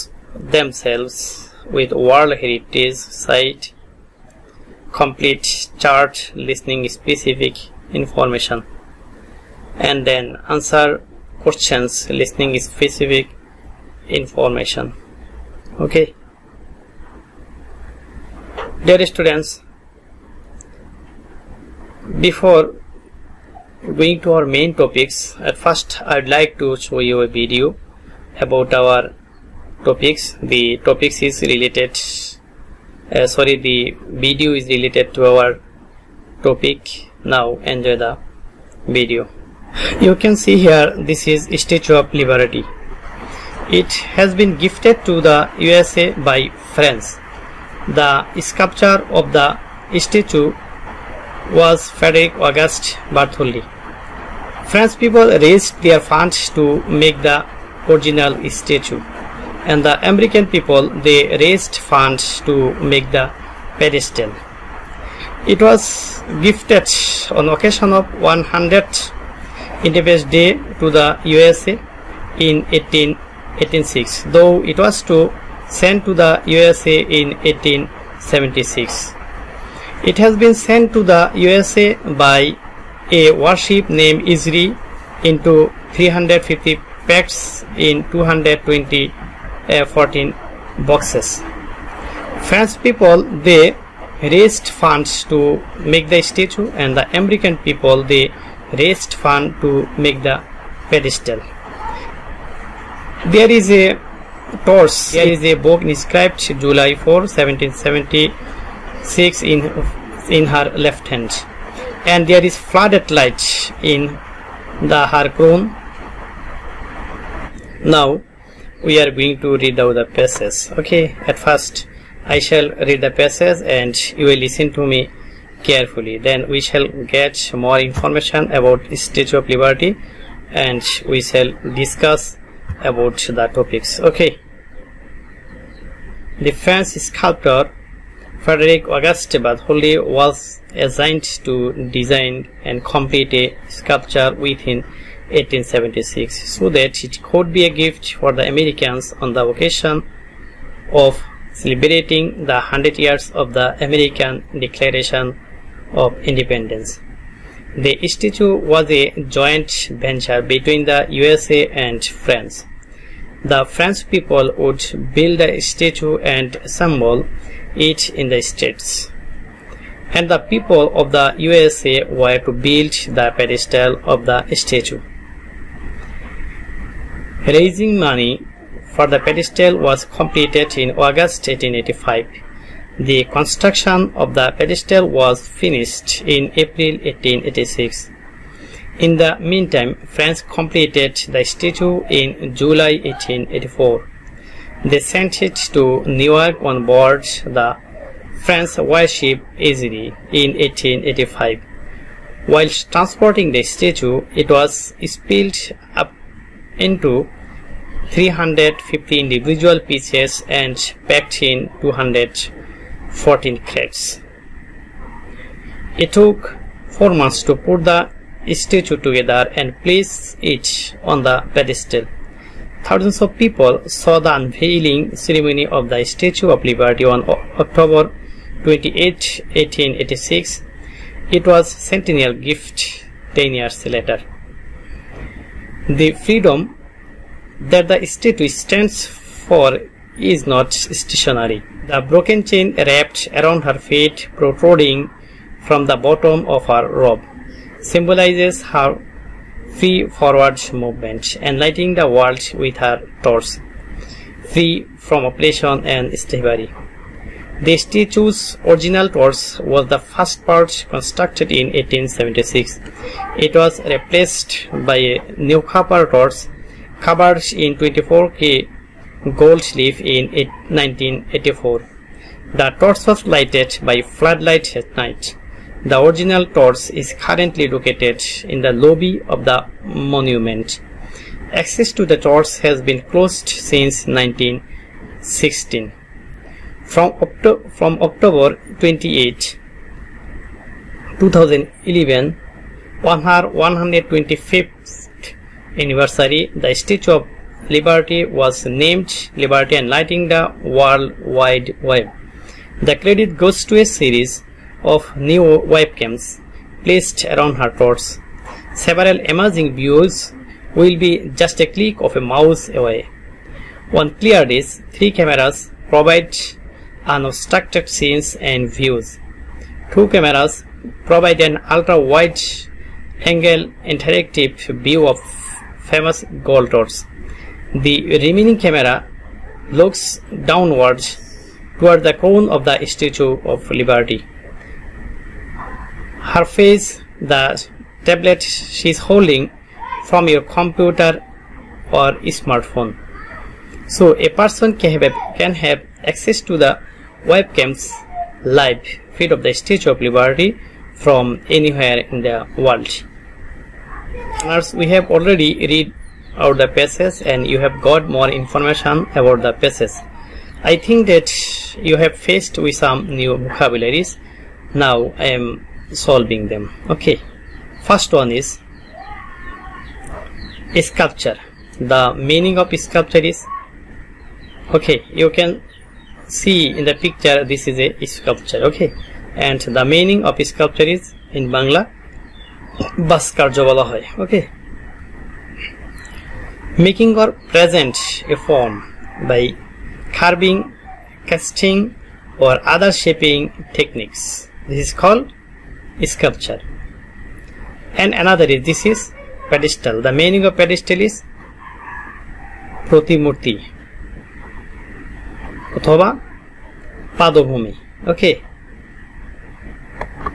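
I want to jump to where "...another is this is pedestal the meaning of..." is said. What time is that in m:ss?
6:38.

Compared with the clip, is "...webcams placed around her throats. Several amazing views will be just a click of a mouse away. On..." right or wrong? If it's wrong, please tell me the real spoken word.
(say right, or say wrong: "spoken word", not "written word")
right.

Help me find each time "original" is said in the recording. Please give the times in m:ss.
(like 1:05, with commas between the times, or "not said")
0:57, 4:18, 4:36.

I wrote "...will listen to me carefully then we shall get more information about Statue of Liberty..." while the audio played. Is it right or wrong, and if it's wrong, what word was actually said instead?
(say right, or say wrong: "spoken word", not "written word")
right.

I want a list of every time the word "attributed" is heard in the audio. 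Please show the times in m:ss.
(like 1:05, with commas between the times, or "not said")
not said.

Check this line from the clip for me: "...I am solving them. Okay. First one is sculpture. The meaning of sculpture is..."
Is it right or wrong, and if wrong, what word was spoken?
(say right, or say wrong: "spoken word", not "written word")
right.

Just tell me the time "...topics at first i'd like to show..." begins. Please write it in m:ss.
0:24.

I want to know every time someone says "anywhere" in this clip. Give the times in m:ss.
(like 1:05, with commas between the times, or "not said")
5:51.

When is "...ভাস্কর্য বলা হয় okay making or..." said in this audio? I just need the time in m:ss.
6:23.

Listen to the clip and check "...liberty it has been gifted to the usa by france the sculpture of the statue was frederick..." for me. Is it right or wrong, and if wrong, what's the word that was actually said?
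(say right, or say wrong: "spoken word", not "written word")
right.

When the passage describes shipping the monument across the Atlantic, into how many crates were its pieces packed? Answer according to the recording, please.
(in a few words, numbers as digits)
214.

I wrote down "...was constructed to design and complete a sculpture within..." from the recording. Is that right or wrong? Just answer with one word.
wrong.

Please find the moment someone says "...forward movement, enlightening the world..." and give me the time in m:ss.
4:10.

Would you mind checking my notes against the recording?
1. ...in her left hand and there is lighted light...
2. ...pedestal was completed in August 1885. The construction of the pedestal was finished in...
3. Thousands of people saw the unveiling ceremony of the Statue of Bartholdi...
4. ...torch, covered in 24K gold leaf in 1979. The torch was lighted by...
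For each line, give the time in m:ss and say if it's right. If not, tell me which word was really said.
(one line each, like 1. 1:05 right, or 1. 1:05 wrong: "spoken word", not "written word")
1. 1:50 wrong: "flooded", not "lighted"
2. 2:59 right
3. 3:42 wrong: "Liberty", not "Bartholdi"
4. 4:26 wrong: "1984", not "1979".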